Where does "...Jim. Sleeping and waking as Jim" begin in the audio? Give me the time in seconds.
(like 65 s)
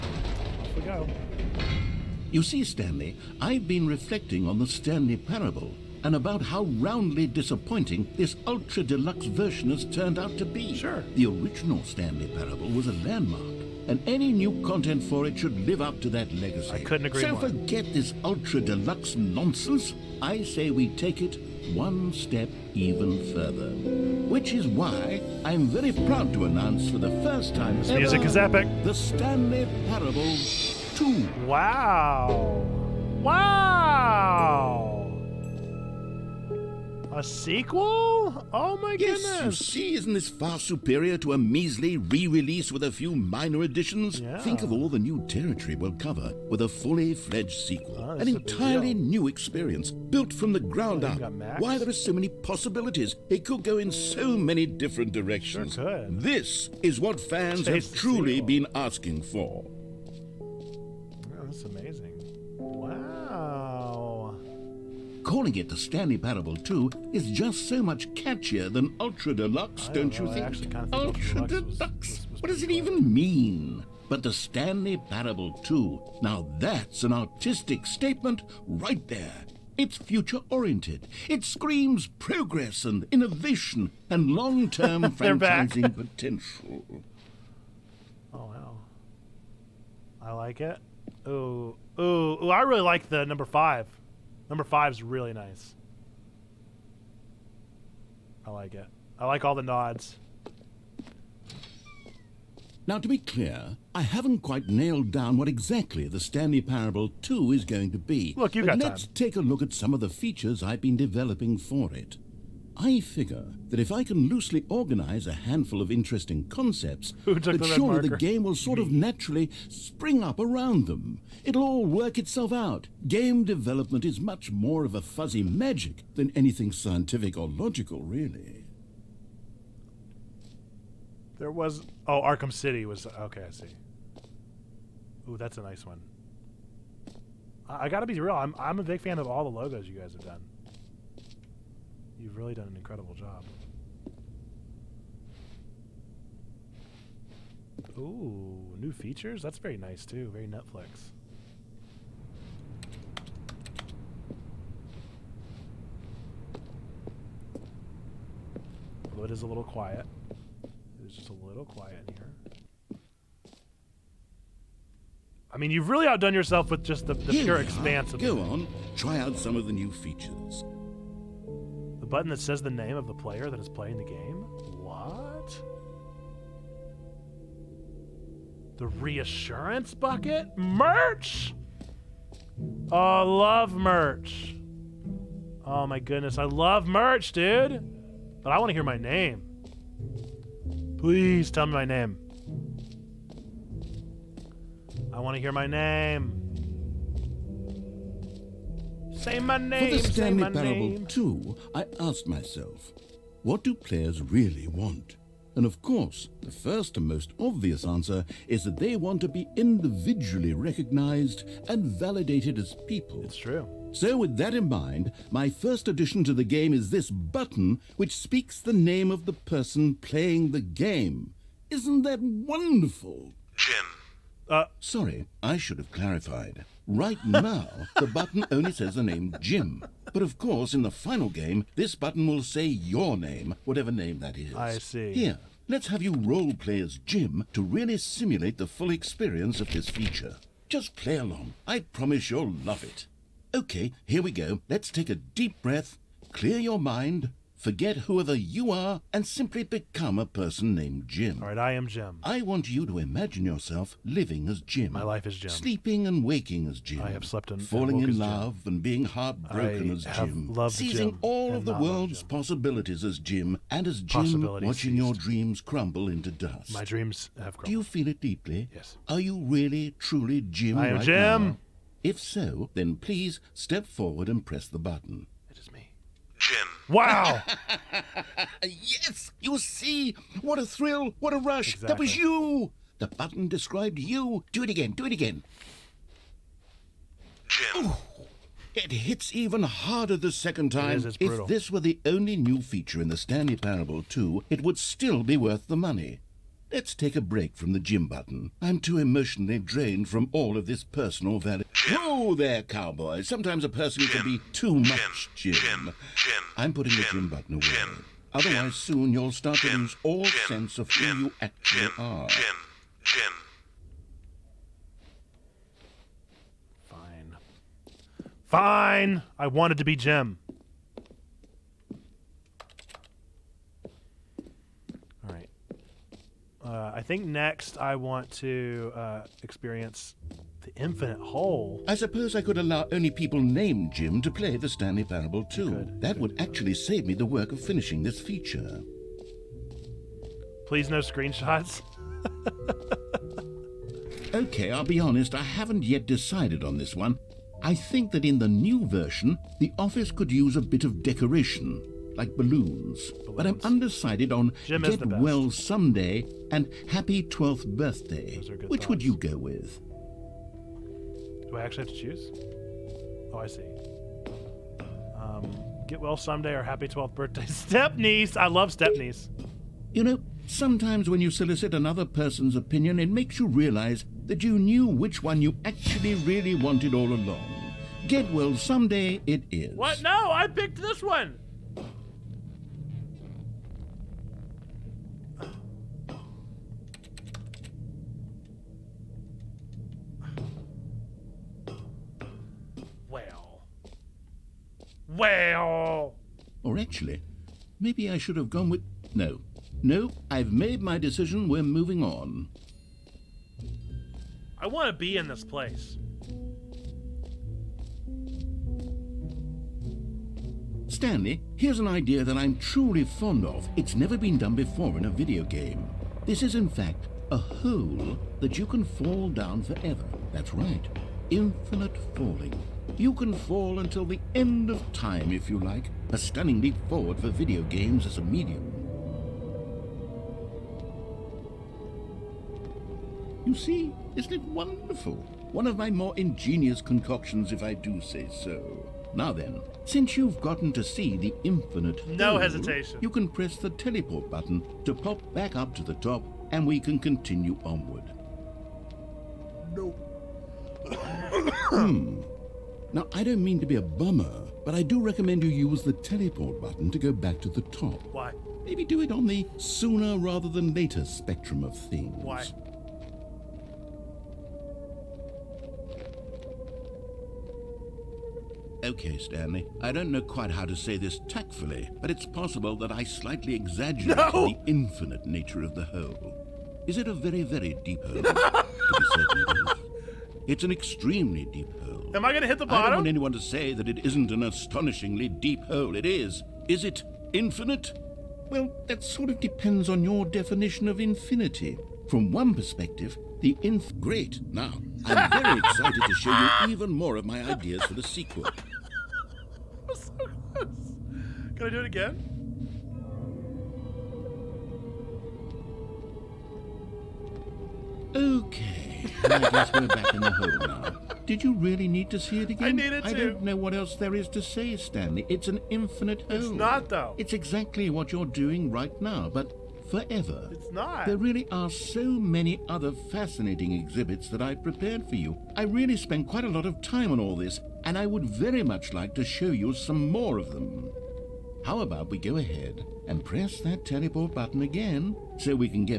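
255 s.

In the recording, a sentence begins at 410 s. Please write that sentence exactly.
Stanley, here's an idea that I'm truly fond of.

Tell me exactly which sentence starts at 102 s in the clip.
Now, to be clear, I haven't quite nailed down what exactly the Stanley Parable 2 is going to be.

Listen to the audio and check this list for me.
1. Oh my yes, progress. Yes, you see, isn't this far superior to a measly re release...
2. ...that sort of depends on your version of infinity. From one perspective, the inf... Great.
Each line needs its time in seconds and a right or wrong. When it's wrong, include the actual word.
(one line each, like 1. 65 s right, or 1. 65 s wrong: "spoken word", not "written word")
1. 38 s wrong: "goodness", not "progress"
2. 488 s wrong: "definition", not "version".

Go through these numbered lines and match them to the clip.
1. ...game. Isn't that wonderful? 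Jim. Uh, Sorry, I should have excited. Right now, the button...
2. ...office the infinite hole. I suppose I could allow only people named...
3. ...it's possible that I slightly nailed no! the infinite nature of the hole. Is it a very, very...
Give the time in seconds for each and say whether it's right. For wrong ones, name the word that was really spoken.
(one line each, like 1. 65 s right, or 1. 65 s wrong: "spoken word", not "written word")
1. 220 s wrong: "clarified", not "excited"
2. 329 s wrong: "experience", not "office"
3. 472 s wrong: "exaggerated", not "nailed".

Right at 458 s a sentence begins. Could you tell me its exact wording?
Maybe do it on the sooner rather than later spectrum of things.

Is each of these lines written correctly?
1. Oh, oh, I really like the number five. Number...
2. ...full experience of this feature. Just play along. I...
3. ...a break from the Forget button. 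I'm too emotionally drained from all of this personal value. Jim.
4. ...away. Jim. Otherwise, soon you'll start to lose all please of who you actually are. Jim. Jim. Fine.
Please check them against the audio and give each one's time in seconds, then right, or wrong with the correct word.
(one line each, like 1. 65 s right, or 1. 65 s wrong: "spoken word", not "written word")
1. 91 s right
2. 238 s right
3. 297 s wrong: "Jim", not "Forget"
4. 307 s wrong: "sense", not "please".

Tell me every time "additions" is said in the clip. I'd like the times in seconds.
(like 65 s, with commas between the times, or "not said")
43 s, 215 s.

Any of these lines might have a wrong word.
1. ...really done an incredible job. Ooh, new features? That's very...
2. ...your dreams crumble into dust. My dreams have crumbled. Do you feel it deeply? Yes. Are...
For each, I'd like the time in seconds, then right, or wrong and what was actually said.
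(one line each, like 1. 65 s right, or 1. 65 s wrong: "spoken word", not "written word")
1. 142 s right
2. 264 s right.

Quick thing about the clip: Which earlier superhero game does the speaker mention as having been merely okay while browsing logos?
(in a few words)
Arkham City.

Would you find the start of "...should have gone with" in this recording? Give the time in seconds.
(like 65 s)
398 s.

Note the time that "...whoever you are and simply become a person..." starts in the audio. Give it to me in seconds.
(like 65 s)
247 s.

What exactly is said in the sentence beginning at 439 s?
Now then, since you've gotten to see the infinite...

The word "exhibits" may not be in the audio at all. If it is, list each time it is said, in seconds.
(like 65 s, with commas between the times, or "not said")
523 s.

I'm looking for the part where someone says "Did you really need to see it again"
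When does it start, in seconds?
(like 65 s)
511 s.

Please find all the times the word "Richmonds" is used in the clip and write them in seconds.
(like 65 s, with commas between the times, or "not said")
not said.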